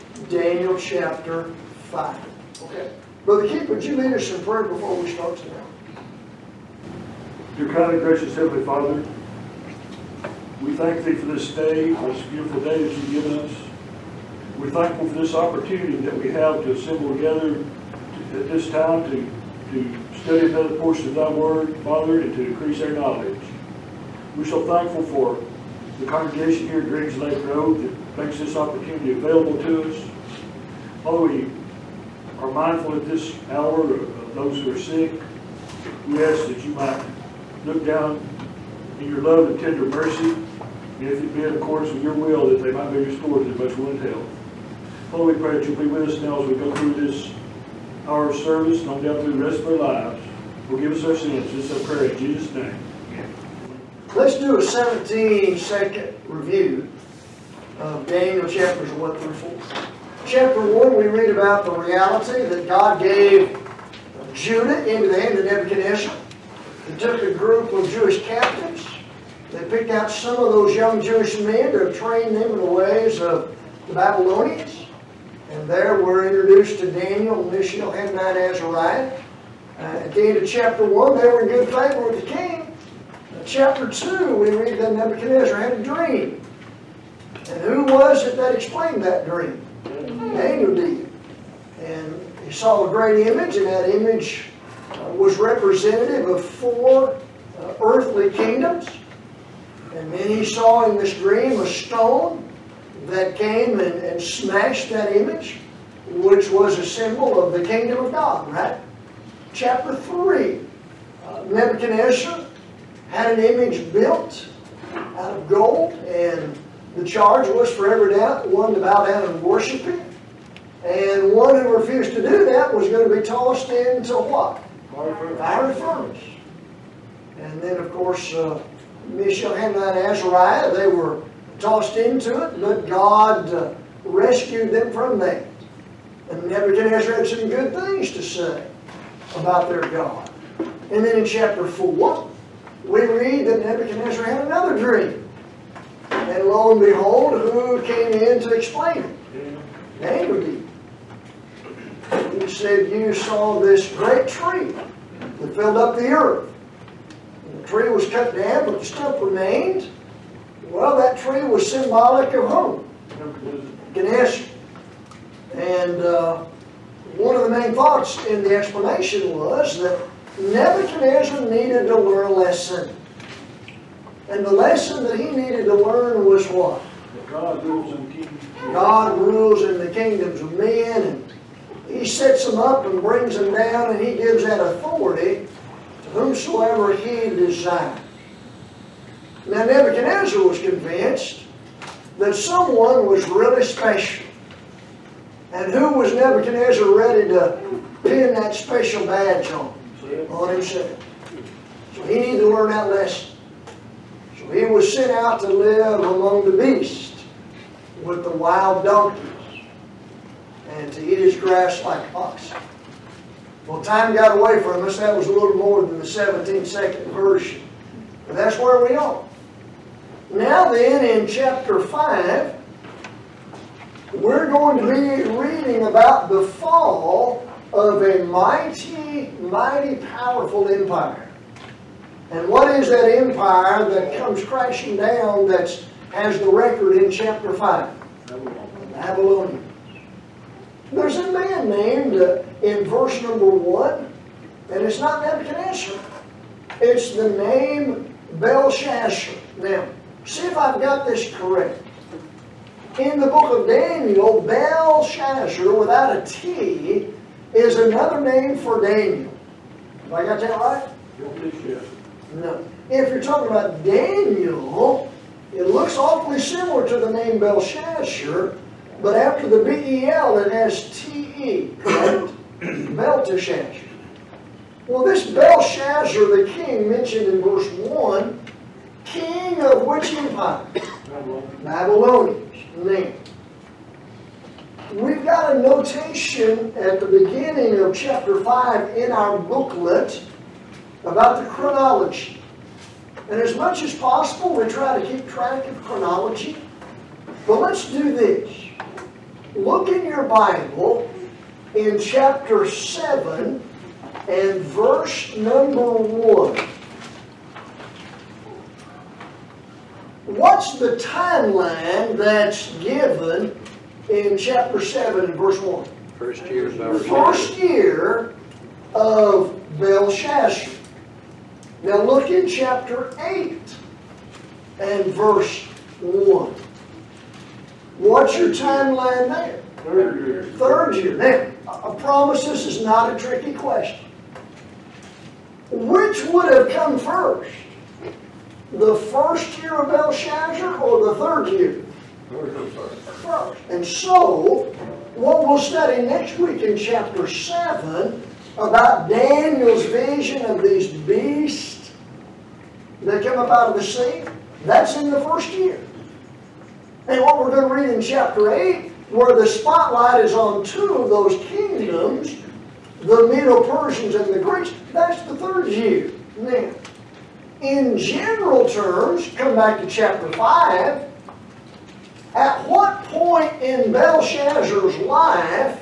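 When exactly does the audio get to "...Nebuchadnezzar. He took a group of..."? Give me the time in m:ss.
1:05.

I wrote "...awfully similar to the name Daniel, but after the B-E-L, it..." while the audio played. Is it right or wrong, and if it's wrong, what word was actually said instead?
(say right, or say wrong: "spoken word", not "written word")
wrong: "Belshazzar", not "Daniel".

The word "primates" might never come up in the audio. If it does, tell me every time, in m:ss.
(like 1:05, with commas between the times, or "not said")
not said.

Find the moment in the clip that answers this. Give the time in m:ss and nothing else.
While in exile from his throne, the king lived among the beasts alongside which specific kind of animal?
3:28.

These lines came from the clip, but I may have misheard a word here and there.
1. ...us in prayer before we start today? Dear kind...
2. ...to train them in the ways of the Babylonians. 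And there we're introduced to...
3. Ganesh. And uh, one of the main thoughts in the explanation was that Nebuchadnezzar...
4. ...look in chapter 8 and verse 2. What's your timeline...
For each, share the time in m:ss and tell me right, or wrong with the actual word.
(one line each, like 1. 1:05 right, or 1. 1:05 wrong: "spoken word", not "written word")
1. 0:04 right
2. 1:11 right
3. 2:43 right
4. 5:22 wrong: "1", not "2".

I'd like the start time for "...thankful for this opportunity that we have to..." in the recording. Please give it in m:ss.
0:14.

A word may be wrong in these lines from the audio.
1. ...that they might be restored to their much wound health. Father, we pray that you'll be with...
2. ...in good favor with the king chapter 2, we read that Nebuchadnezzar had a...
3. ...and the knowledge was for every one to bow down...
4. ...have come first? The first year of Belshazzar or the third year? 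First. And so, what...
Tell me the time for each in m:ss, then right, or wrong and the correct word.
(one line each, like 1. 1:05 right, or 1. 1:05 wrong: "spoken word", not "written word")
1. 0:42 right
2. 1:21 right
3. 1:56 wrong: "charge", not "knowledge"
4. 5:36 right.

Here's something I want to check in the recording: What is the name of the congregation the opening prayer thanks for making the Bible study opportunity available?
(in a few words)
Greens Lake Road.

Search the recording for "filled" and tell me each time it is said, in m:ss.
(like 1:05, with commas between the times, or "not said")
2:35.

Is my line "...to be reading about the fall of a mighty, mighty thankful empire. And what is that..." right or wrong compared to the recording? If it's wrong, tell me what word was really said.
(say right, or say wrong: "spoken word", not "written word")
wrong: "powerful", not "thankful".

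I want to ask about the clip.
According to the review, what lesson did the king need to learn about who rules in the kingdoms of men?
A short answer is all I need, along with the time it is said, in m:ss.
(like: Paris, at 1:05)
God rules in kingdoms, at 2:57.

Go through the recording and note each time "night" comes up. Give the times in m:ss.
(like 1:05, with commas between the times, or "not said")
not said.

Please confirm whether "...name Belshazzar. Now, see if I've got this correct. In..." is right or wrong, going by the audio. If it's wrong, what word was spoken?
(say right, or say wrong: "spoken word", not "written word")
right.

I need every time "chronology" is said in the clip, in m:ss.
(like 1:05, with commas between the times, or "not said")
4:51, 4:55.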